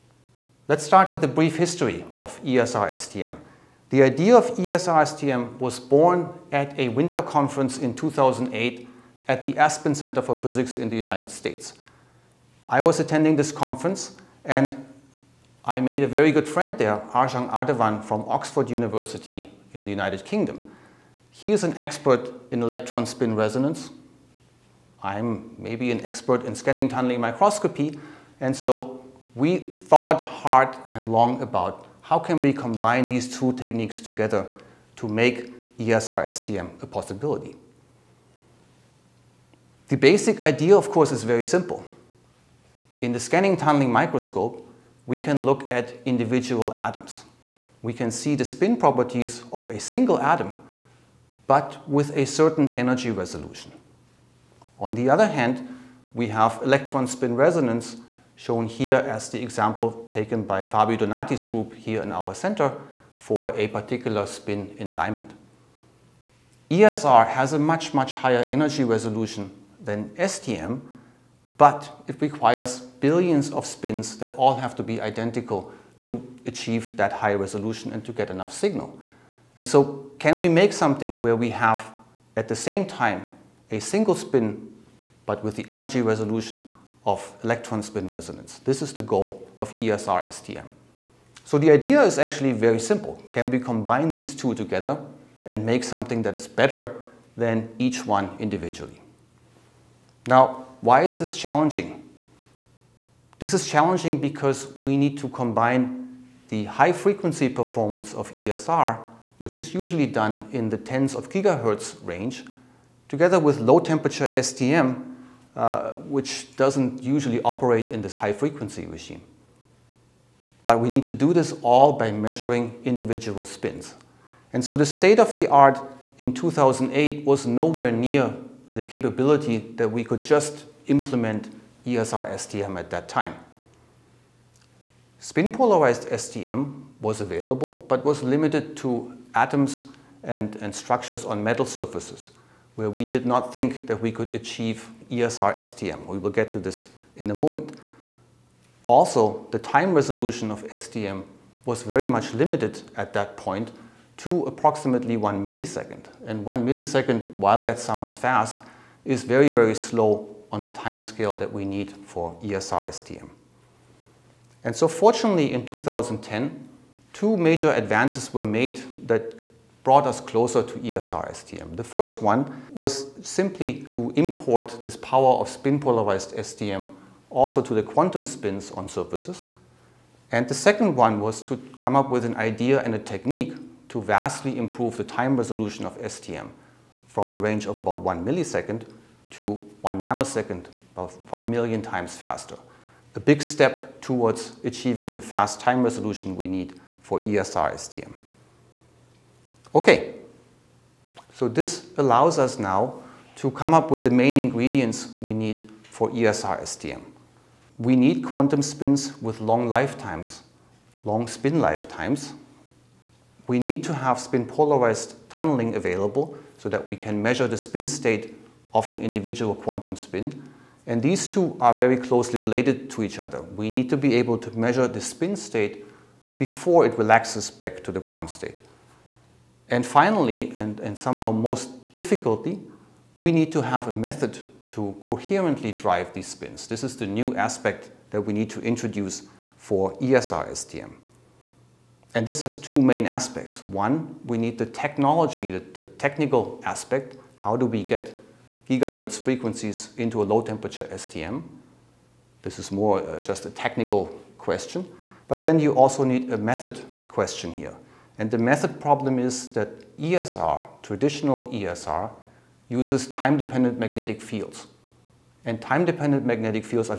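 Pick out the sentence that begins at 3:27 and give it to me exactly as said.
We need quantum spins with long lifetimes, long spin lifetimes.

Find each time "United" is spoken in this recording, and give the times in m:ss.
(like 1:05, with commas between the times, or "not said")
0:10, 0:19.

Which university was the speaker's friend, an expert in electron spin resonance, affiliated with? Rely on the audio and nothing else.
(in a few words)
Oxford University.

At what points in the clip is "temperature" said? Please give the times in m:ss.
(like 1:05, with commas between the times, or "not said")
1:53, 4:10.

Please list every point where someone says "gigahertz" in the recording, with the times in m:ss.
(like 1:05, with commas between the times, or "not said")
1:51, 4:08.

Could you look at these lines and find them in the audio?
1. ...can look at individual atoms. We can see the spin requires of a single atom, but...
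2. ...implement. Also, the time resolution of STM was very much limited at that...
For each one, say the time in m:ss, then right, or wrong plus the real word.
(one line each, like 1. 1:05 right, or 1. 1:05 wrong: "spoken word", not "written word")
1. 0:45 wrong: "properties", not "requires"
2. 2:27 wrong: "moment", not "implement".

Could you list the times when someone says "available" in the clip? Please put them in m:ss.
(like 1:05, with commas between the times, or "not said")
2:17, 3:35.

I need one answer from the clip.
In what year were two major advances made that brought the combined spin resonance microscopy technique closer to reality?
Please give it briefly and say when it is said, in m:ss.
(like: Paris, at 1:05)
2010, at 2:45.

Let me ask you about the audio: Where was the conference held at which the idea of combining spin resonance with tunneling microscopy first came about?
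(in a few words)
Aspen Center for Physics.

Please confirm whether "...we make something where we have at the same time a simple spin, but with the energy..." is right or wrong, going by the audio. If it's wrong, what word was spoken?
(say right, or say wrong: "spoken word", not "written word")
wrong: "single", not "simple".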